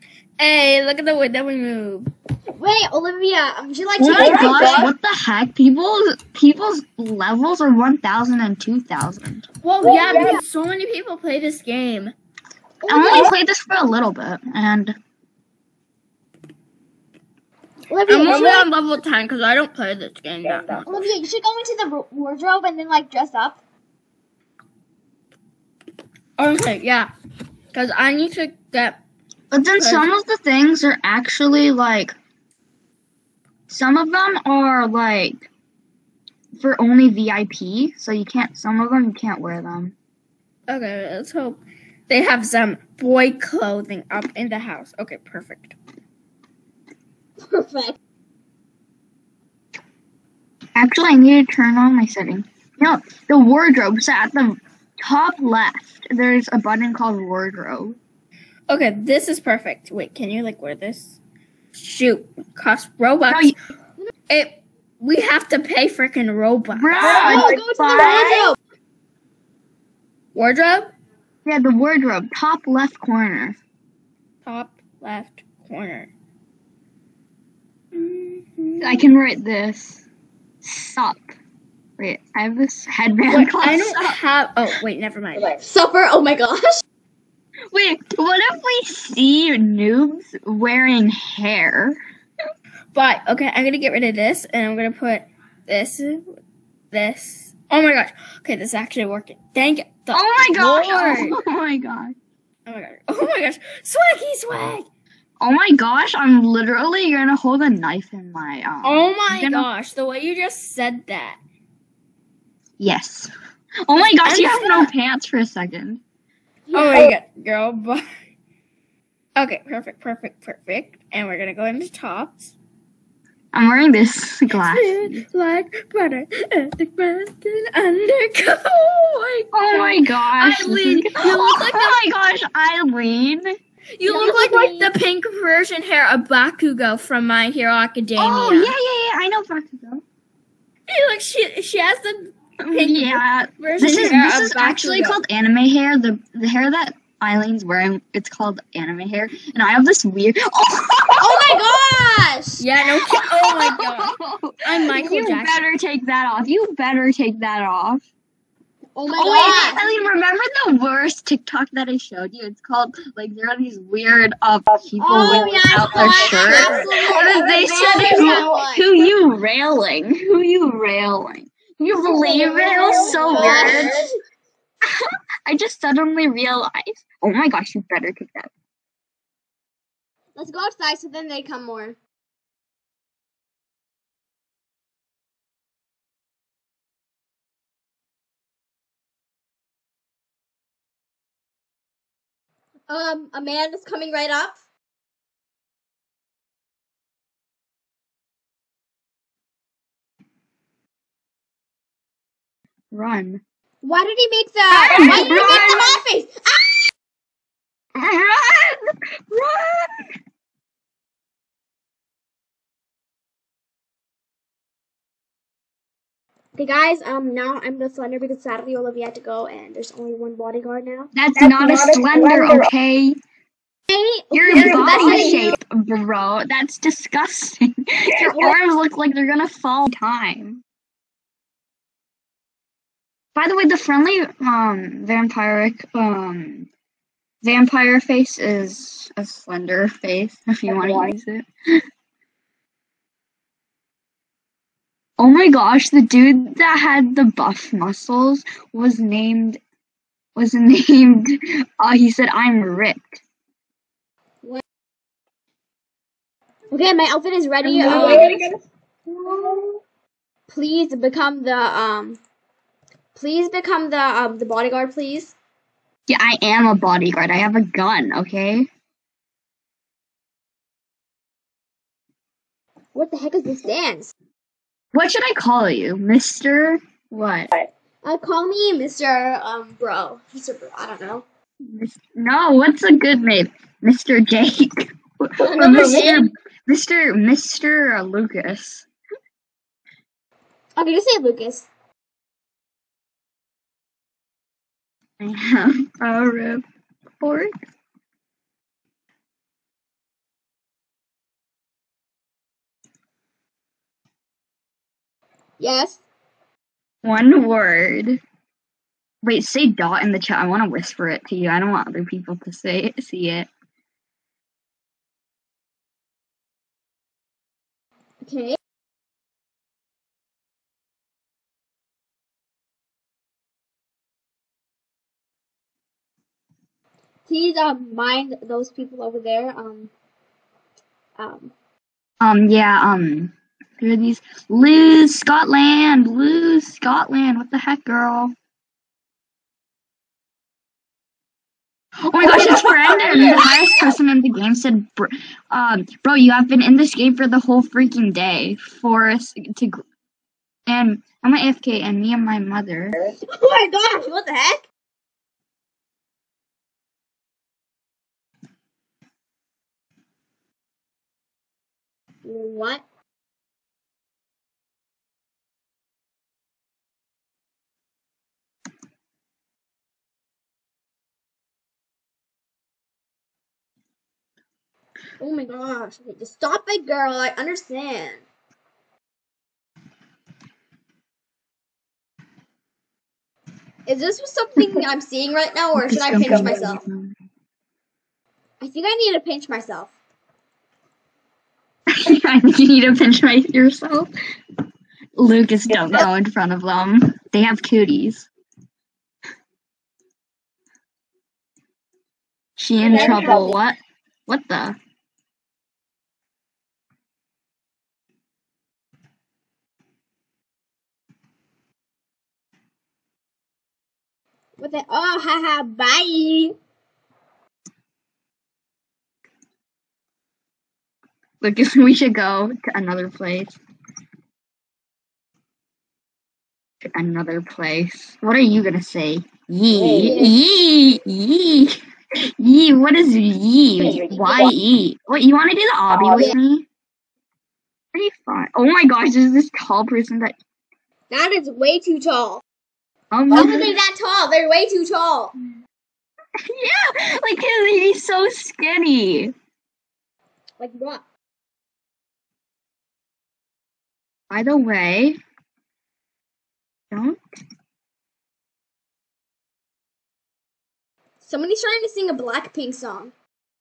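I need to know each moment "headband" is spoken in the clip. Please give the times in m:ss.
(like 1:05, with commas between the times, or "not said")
1:22.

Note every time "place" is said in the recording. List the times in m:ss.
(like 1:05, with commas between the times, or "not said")
7:03, 7:07.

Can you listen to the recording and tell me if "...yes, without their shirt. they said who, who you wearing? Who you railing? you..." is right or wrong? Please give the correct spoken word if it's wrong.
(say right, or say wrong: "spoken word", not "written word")
wrong: "railing", not "wearing".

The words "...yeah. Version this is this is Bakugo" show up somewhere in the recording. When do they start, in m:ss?
2:22.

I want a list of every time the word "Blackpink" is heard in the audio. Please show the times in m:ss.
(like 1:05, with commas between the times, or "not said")
7:42.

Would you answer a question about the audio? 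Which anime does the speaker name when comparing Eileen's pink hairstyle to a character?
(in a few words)
My Hero Academia.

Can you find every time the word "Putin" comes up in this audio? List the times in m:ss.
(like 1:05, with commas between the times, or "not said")
not said.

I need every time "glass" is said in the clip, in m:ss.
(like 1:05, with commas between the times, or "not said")
2:04.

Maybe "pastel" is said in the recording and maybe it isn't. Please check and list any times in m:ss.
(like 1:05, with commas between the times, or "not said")
not said.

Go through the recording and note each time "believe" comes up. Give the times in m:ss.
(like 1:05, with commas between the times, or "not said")
2:52.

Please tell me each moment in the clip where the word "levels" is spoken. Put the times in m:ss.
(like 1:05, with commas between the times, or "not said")
0:06, 0:18.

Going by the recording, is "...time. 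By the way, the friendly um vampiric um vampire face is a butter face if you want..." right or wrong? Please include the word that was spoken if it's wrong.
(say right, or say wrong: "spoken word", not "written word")
wrong: "slender", not "butter".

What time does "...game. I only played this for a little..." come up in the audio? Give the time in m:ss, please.
0:11.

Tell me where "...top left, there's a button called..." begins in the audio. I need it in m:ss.
0:55.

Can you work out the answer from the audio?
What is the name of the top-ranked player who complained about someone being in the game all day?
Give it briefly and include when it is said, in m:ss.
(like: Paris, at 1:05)
Brandon, at 5:42.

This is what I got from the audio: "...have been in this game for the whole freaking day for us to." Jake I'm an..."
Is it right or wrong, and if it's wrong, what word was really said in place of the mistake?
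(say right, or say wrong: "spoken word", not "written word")
wrong: "And", not "Jake".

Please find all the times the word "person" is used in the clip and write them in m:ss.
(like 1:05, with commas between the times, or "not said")
5:43, 7:19.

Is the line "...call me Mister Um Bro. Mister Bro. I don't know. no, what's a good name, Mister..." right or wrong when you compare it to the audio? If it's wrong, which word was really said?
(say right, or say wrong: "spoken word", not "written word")
right.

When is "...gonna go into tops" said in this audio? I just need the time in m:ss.
2:01.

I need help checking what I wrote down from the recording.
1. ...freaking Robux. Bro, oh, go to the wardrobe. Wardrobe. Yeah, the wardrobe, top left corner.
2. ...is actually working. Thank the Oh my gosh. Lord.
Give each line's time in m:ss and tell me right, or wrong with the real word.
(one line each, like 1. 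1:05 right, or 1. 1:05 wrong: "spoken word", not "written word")
1. 1:05 right
2. 1:38 right.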